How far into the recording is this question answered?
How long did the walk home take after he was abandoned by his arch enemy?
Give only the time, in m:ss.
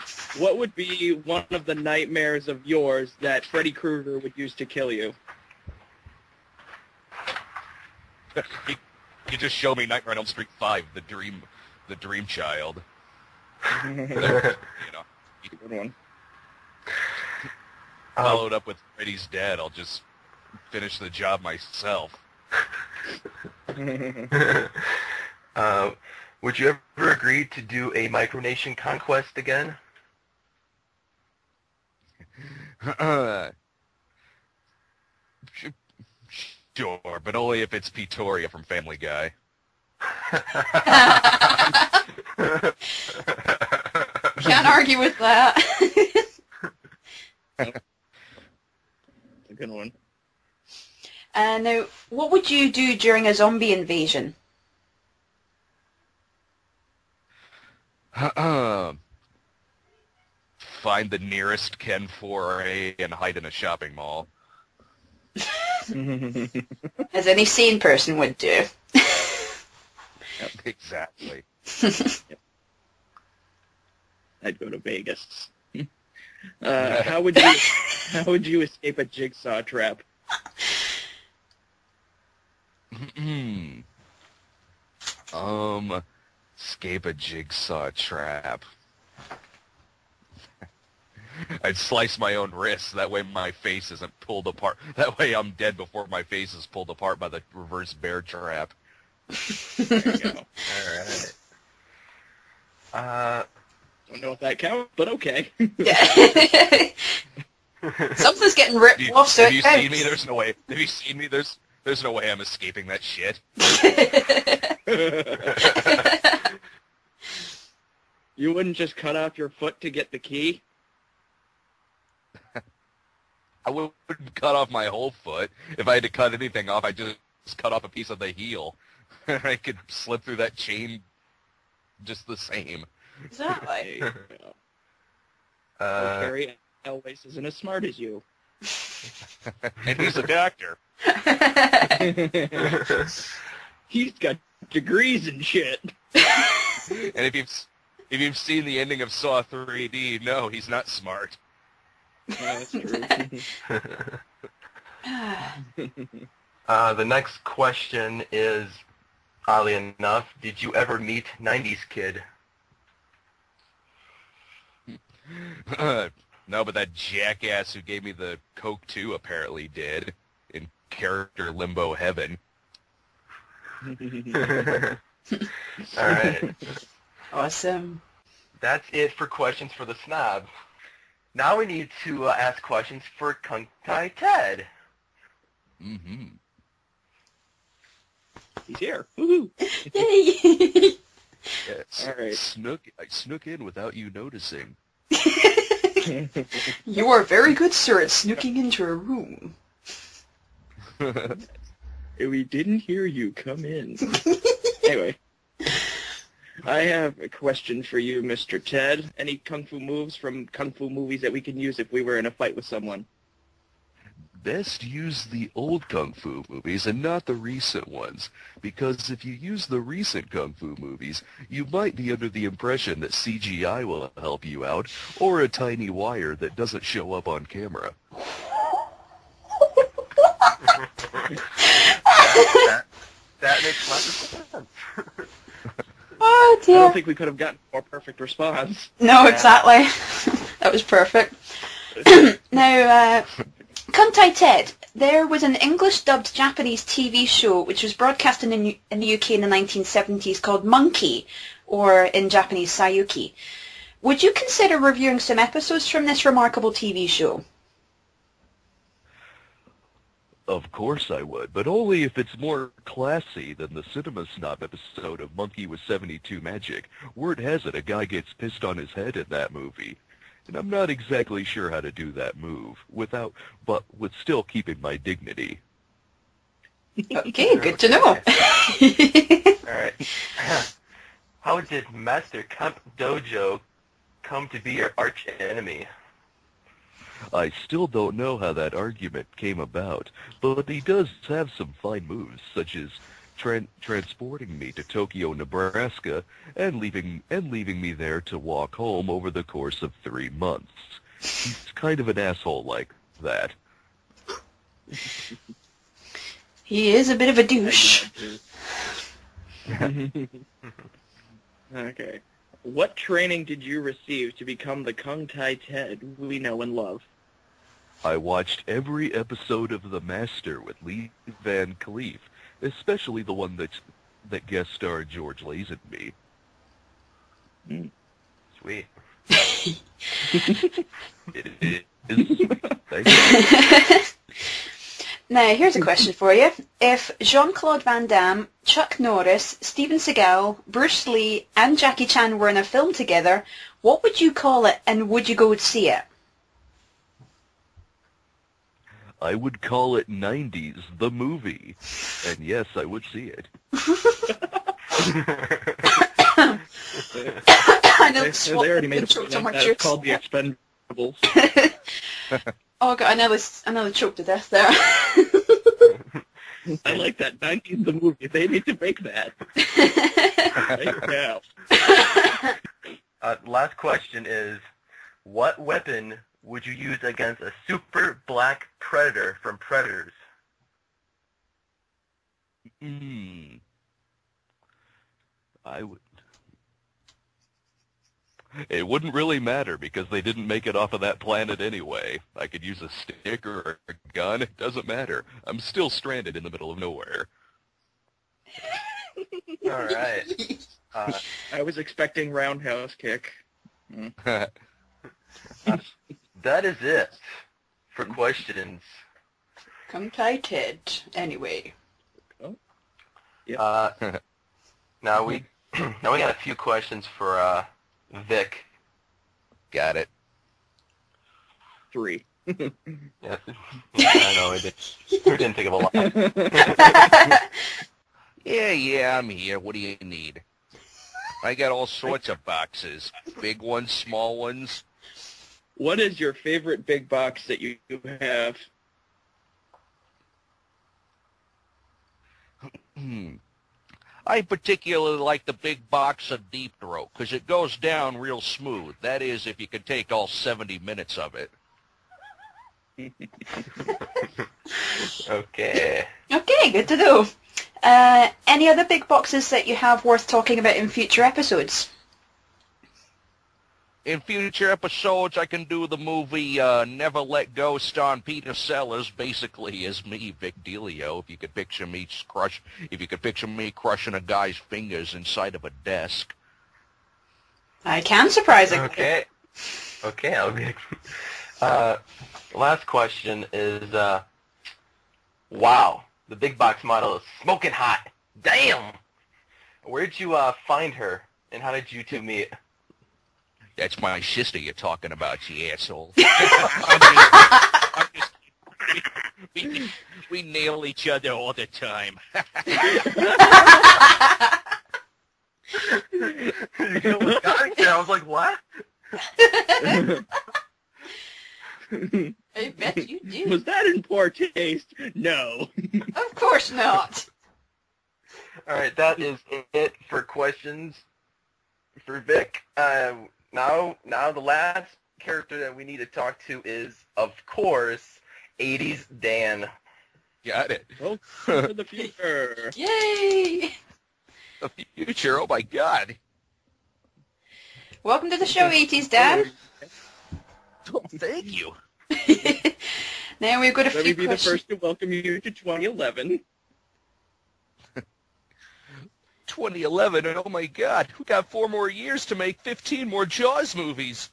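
5:00.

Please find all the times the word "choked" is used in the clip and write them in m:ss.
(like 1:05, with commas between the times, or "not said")
6:03.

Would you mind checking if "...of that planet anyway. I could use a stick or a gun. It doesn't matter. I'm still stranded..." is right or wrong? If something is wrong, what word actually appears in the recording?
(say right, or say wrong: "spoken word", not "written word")
right.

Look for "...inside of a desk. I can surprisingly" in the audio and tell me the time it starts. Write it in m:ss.
7:55.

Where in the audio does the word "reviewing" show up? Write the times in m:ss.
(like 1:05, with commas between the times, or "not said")
4:14.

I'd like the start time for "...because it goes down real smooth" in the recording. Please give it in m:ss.
7:27.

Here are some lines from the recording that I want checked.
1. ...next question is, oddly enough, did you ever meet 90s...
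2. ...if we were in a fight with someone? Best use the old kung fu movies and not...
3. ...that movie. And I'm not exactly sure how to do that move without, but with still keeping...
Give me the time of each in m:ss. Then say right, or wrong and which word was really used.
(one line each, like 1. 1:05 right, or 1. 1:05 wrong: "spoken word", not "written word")
1. 2:37 right
2. 3:31 right
3. 4:29 right.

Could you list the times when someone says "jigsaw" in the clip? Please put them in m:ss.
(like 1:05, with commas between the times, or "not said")
1:19, 1:27.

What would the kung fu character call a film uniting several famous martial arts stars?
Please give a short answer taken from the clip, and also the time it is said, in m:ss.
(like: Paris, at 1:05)
90s, the movie, at 5:50.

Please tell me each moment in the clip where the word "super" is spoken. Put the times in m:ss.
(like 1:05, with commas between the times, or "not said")
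6:17.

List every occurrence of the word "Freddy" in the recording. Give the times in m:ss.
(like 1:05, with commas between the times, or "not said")
0:03, 0:18.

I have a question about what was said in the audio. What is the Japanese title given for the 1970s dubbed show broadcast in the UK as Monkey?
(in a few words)
Sayuki.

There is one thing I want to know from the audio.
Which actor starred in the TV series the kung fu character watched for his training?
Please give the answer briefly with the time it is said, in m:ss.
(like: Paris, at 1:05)
Lee Van Cleef, at 5:20.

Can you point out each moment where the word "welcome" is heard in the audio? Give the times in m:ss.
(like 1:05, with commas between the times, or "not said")
8:50, 8:58, 9:04.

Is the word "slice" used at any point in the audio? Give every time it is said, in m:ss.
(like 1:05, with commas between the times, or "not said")
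1:31.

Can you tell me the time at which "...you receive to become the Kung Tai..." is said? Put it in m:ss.
5:13.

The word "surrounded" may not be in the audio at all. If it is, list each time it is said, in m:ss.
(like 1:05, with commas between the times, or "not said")
not said.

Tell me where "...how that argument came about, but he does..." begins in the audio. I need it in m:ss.
4:48.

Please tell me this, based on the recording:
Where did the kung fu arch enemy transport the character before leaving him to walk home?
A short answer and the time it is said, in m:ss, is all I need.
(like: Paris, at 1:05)
Tokyo, Nebraska, at 4:54.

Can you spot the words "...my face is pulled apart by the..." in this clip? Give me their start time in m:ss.
1:36.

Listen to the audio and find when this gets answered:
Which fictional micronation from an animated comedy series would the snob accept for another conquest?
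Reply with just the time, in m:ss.
0:37.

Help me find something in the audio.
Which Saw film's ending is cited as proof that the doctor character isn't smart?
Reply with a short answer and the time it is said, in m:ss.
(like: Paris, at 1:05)
Saw 3D, at 2:29.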